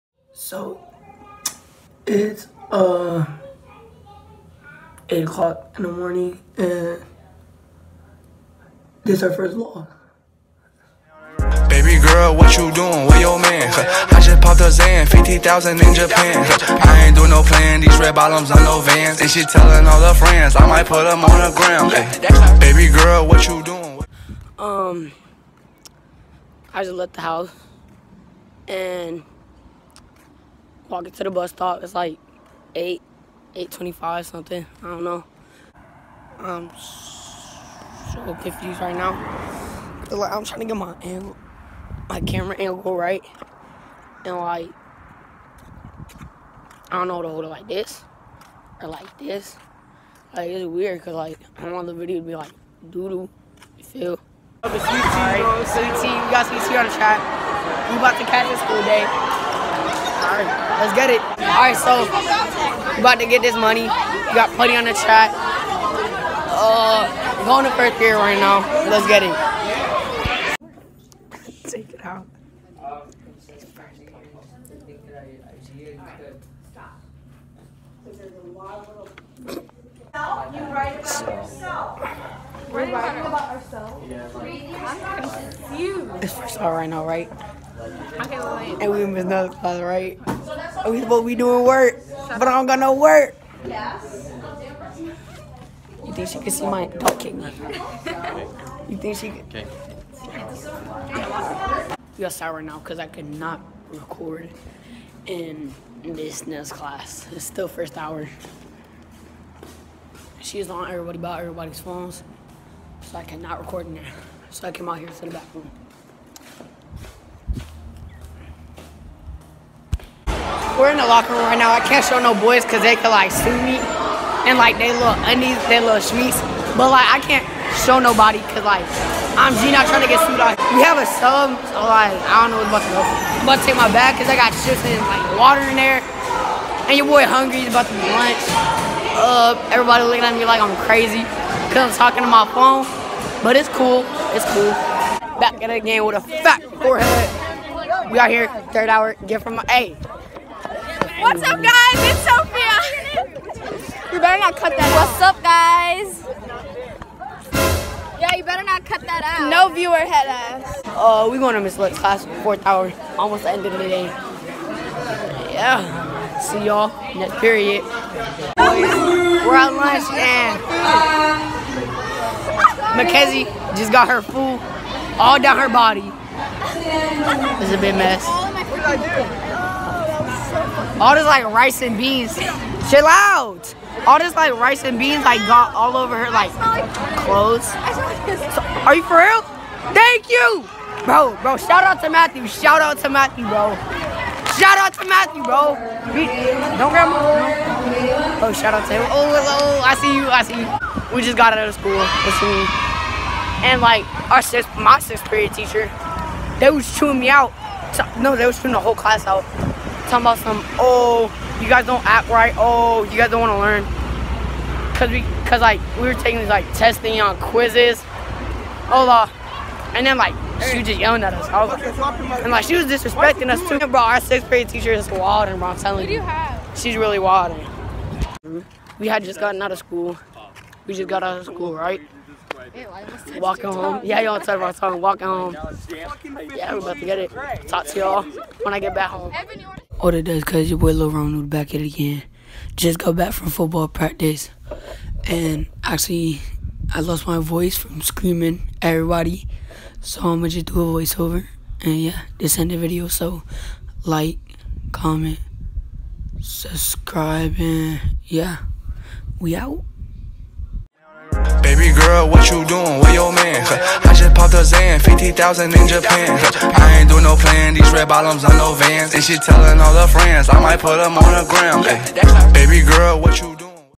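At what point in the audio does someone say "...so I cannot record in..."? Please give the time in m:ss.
1:53.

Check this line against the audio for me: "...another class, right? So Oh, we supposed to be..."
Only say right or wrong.
right.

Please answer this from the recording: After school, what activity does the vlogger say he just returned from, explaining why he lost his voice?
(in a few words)
Football practice.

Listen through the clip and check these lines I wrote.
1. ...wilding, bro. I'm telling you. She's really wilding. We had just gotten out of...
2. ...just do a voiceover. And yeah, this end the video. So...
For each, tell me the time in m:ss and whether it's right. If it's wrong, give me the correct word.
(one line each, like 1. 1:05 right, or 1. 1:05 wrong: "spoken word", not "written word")
1. 3:45 right
2. 4:10 right.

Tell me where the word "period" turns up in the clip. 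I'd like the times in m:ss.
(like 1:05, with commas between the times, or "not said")
2:47, 3:25.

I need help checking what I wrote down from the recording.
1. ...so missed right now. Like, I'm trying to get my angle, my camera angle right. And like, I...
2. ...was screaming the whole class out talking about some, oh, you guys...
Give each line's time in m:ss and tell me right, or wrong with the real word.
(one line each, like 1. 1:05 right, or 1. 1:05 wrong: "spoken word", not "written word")
1. 0:36 wrong: "confused", not "missed"
2. 3:28 wrong: "chewing", not "screaming".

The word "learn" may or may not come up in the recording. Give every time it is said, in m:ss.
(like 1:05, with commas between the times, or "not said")
3:33.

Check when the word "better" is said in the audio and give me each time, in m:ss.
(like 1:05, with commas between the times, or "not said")
2:34, 2:38.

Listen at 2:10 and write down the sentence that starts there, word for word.
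Like we have a sub, so like I don't know what's about to go.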